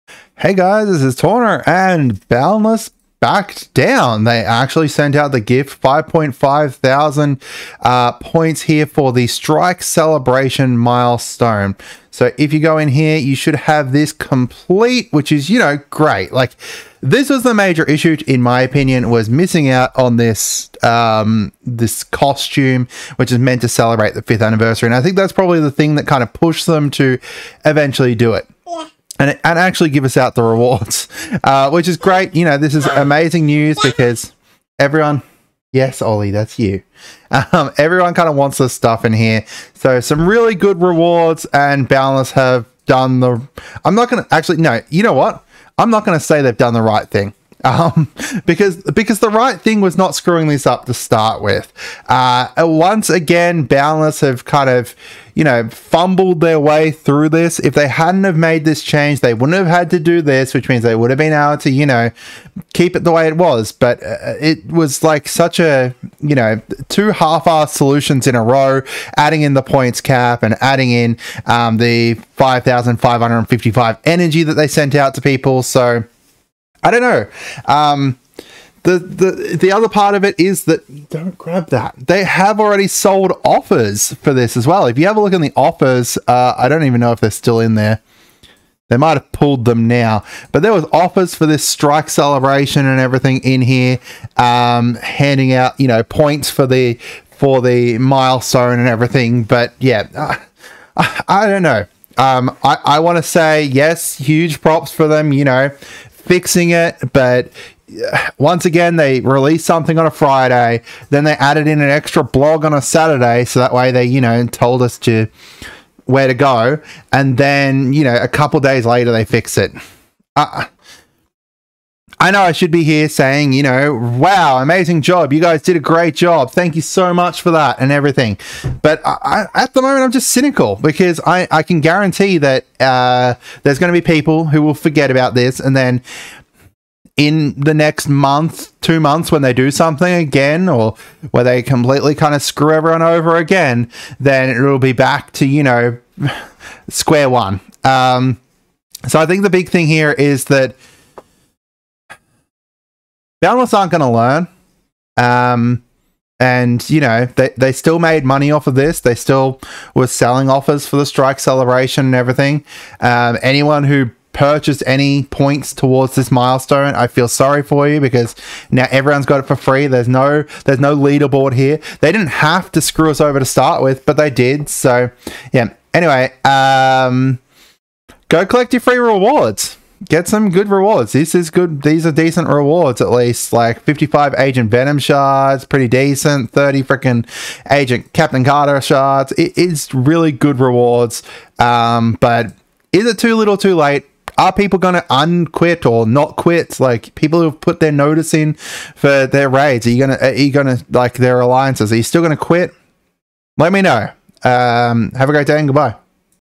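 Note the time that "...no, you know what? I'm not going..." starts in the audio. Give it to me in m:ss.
0:44.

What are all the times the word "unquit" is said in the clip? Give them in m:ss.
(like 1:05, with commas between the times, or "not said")
3:15.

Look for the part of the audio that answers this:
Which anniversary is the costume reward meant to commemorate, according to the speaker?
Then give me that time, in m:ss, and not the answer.
0:24.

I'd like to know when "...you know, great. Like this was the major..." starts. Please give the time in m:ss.
0:15.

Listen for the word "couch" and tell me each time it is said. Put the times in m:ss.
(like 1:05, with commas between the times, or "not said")
not said.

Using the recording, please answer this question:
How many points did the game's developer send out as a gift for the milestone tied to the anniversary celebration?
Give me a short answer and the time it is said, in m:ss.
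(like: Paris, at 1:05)
5,500, at 0:05.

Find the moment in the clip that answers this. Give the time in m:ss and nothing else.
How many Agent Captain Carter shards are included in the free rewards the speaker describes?
3:06.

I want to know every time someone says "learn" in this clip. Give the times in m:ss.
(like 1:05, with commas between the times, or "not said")
2:34.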